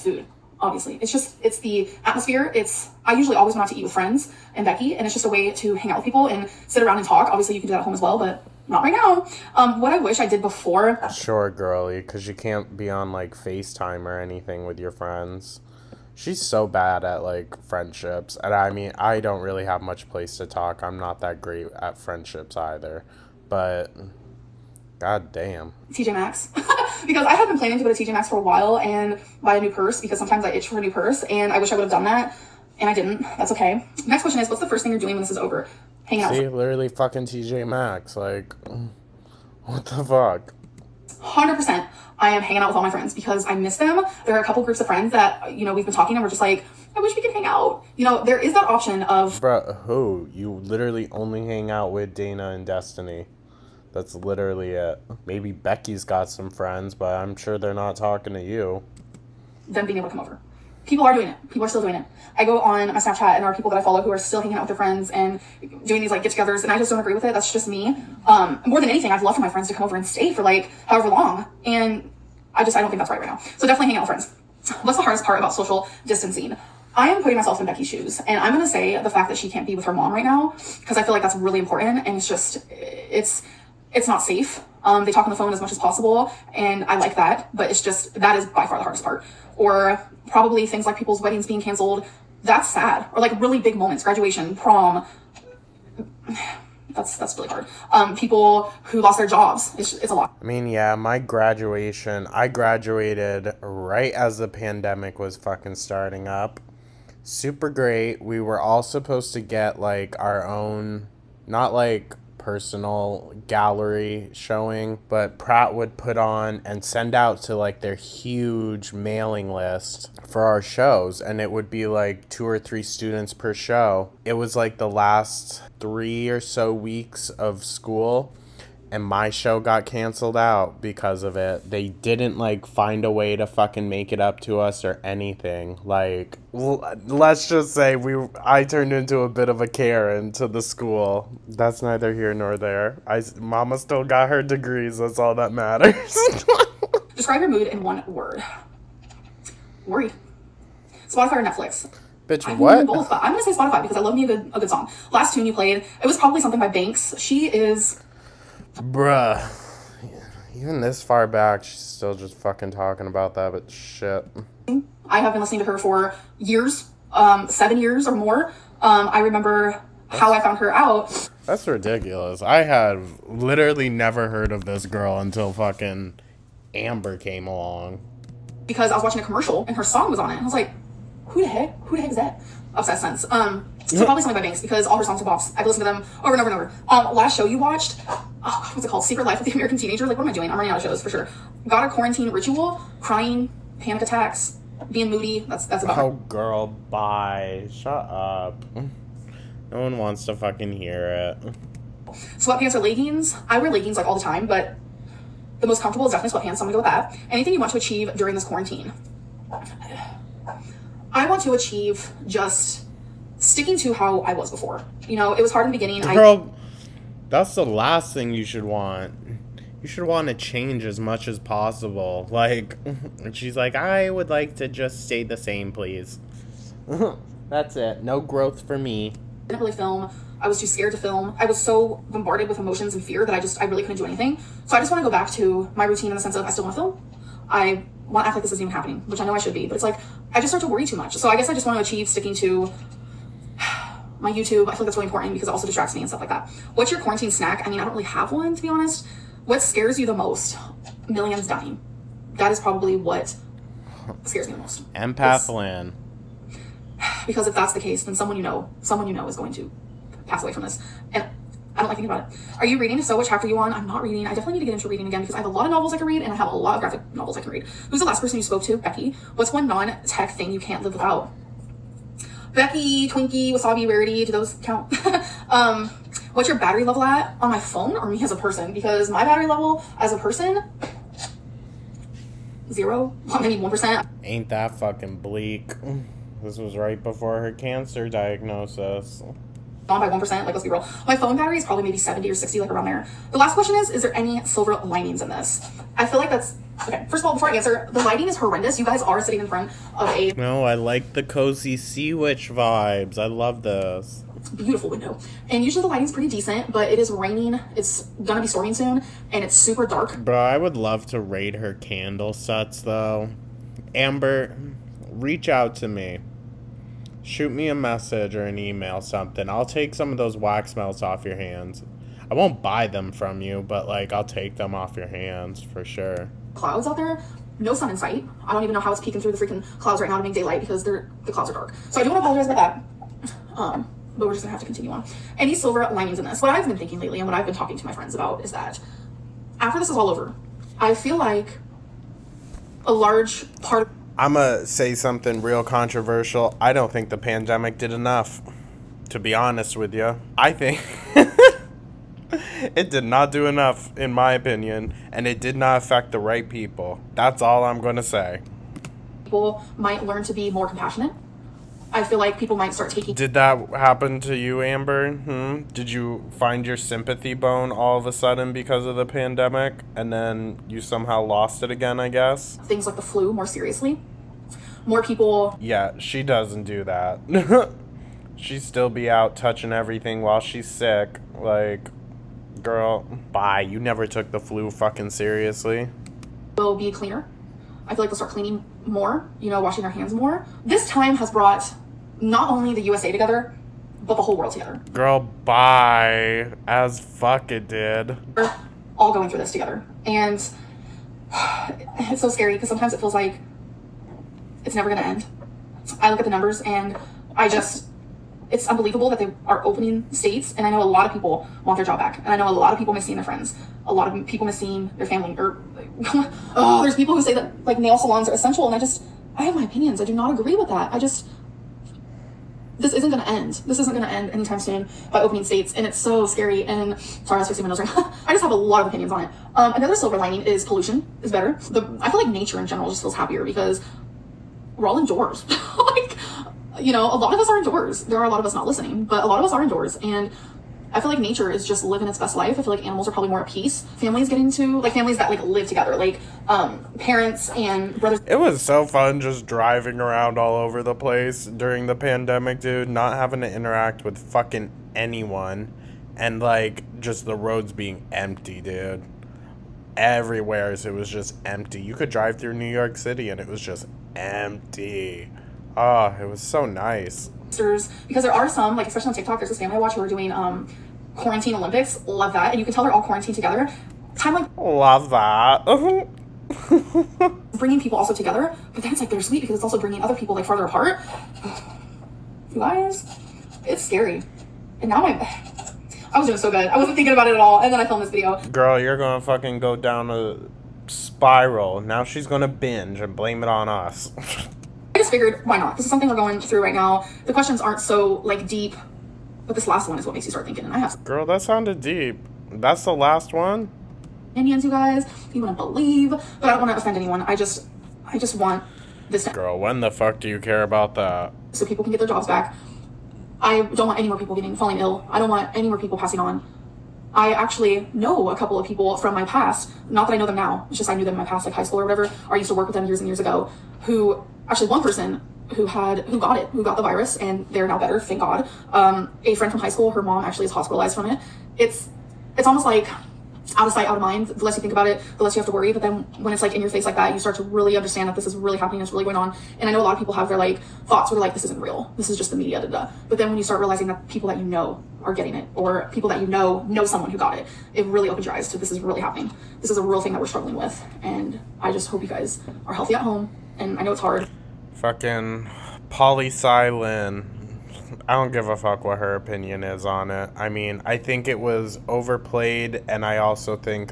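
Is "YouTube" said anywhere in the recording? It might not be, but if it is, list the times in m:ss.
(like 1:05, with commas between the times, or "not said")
4:04.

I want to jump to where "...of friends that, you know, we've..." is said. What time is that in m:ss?
0:44.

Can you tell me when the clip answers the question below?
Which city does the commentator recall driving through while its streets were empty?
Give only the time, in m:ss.
7:42.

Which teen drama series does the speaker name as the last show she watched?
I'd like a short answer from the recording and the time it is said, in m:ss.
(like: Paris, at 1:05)
Secret Life of the American Teenager, at 3:09.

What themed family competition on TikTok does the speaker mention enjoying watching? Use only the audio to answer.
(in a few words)
Quarantine Olympics.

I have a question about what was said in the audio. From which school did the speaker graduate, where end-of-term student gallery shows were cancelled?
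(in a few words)
Pratt.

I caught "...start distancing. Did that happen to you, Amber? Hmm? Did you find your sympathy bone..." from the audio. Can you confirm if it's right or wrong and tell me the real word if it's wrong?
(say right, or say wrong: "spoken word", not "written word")
wrong: "taking", not "distancing".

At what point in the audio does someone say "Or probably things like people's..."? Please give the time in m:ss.
1:29.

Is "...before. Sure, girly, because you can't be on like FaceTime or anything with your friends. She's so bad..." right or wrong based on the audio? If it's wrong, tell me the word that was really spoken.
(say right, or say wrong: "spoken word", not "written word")
right.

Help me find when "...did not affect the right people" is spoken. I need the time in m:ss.
5:55.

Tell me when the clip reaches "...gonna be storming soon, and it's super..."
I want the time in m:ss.
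5:08.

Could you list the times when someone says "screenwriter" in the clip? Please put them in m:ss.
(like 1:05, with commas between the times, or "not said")
not said.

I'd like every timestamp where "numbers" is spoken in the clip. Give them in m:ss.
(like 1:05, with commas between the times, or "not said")
6:46.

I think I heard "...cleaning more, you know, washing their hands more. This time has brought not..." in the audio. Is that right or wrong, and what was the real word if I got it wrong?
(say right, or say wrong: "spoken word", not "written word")
right.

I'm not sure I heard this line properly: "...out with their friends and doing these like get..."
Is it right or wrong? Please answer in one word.
right.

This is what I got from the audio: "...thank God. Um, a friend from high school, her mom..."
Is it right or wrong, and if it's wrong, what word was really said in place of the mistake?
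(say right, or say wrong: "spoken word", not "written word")
right.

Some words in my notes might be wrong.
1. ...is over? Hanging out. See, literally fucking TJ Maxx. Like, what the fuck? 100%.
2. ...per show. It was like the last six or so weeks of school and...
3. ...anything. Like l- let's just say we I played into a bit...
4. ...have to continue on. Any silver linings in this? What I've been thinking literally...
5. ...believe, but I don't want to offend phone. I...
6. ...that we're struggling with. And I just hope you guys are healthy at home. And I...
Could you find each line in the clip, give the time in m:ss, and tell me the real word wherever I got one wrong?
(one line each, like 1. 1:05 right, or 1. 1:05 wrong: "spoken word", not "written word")
1. 0:35 right
2. 2:03 wrong: "three", not "six"
3. 2:15 wrong: "turned", not "played"
4. 5:34 wrong: "lately", not "literally"
5. 8:25 wrong: "anyone", not "phone"
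6. 9:10 right.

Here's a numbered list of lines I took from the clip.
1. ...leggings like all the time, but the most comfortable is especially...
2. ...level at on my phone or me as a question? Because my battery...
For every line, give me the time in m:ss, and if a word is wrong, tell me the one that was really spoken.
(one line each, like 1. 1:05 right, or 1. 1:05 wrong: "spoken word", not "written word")
1. 3:23 wrong: "definitely", not "especially"
2. 4:36 wrong: "person", not "question".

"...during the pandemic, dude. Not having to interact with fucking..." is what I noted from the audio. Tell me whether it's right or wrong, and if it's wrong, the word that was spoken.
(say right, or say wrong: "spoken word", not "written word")
right.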